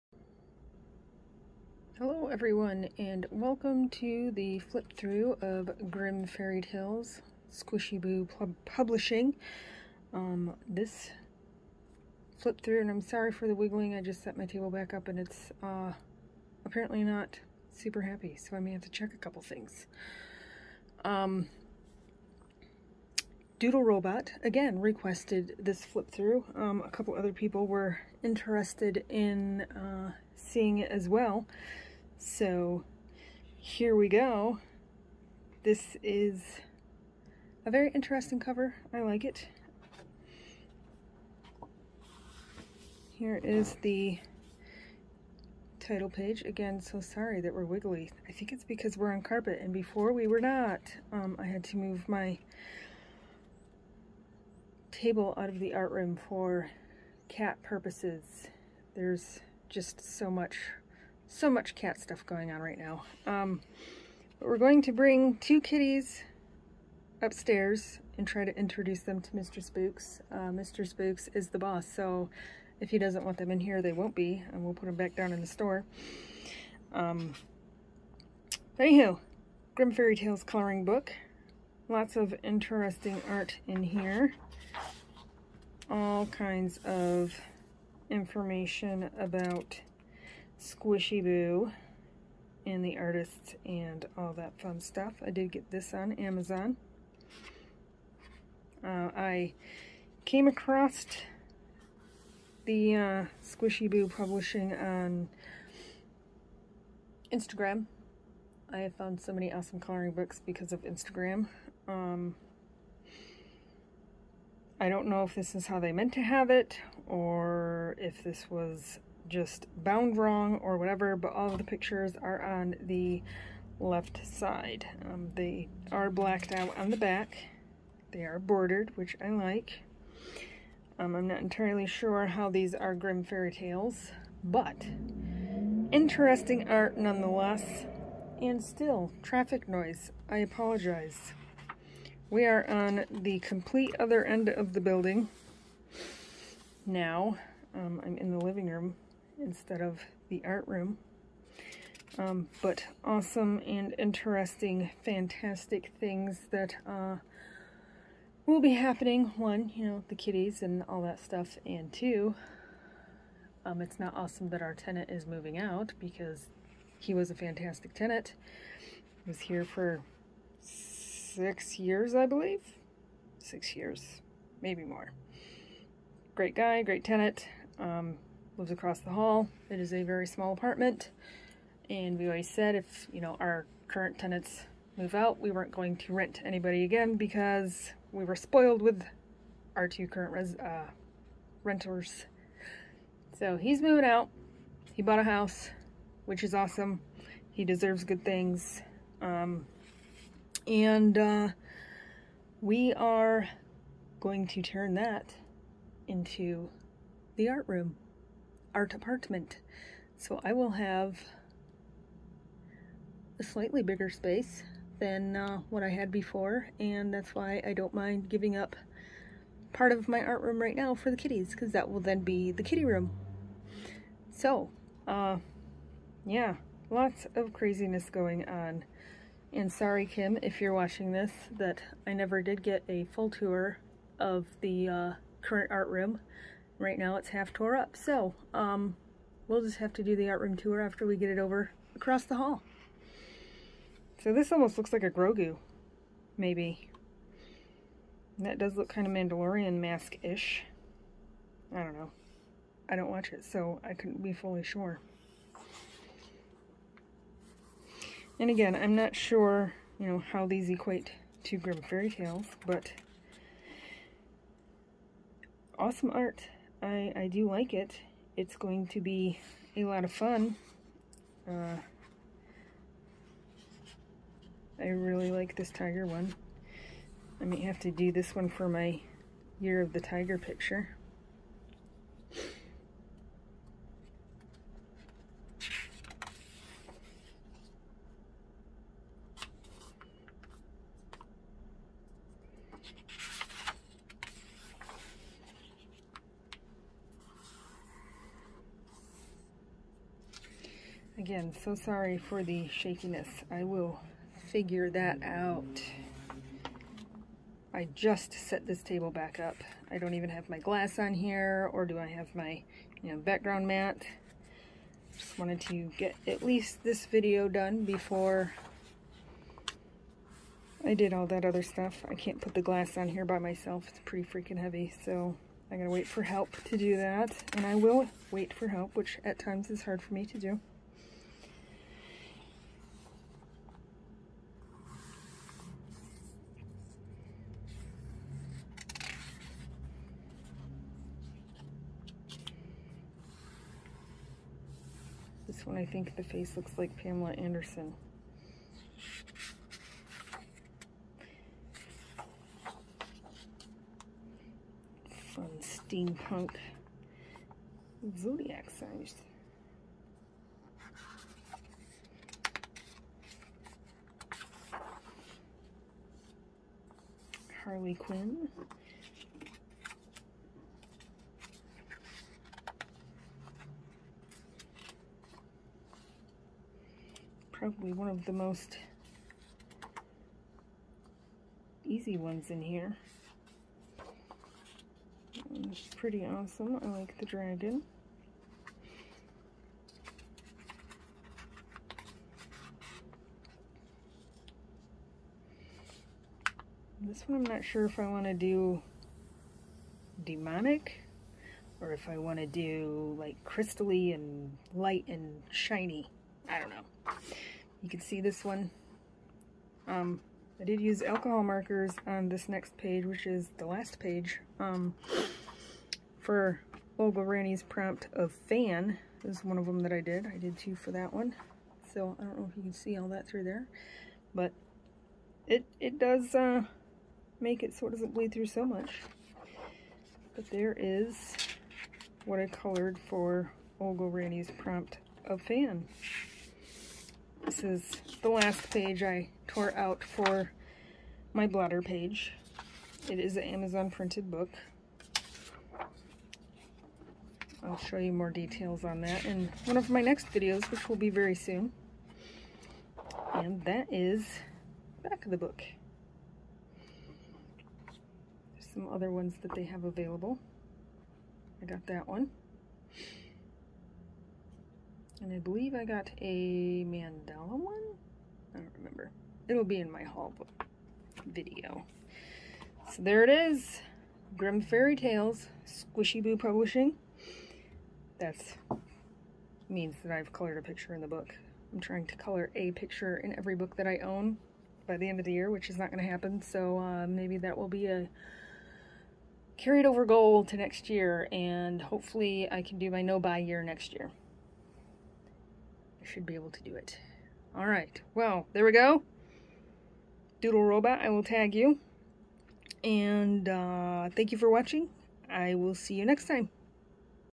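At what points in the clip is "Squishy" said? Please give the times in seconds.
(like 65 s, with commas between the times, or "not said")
7 s, 90 s, 103 s, 475 s.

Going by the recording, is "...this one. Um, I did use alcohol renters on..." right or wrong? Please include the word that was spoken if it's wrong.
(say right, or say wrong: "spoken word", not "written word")
wrong: "markers", not "renters".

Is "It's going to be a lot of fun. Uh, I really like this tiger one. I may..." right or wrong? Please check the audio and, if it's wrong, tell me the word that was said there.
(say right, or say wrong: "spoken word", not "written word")
right.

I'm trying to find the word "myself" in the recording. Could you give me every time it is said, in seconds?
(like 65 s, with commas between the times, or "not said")
323 s.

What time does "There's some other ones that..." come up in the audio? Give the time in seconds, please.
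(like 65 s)
458 s.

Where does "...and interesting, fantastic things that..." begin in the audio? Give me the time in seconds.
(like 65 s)
153 s.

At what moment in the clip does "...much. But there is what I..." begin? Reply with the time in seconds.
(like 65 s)
428 s.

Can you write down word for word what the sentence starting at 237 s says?
So um, we'll just have to do the art room tour after we get it over across the hall.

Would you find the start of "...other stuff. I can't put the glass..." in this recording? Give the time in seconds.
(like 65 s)
321 s.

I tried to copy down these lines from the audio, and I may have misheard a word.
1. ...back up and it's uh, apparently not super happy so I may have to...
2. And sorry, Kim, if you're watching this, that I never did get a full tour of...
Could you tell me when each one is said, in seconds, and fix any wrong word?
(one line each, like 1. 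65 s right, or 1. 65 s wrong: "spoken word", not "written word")
1. 14 s right
2. 229 s right.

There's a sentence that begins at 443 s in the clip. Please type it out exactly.
It is an Amazon printed book.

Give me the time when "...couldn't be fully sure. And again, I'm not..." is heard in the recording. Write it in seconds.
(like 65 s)
253 s.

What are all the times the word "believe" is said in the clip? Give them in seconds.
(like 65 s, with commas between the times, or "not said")
172 s, 465 s.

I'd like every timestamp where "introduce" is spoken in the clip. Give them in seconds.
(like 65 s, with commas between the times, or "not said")
68 s.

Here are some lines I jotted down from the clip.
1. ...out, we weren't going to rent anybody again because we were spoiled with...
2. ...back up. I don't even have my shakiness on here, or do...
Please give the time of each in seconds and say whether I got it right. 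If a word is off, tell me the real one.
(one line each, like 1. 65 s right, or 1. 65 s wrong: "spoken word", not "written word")
1. 185 s right
2. 309 s wrong: "glass", not "shakiness".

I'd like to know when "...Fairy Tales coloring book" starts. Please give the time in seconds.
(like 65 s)
79 s.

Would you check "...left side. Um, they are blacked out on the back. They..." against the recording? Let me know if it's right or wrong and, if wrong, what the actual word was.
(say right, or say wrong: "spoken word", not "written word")
right.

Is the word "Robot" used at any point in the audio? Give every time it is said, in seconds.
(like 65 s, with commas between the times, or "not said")
23 s, 500 s.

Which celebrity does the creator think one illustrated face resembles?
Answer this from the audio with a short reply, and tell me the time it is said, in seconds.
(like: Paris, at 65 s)
Pamela Anderson, at 346 s.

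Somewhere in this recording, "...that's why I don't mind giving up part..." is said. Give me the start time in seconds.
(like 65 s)
217 s.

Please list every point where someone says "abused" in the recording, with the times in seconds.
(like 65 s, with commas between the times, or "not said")
not said.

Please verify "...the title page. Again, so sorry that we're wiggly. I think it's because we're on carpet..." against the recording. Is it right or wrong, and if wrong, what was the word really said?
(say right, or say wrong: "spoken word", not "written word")
right.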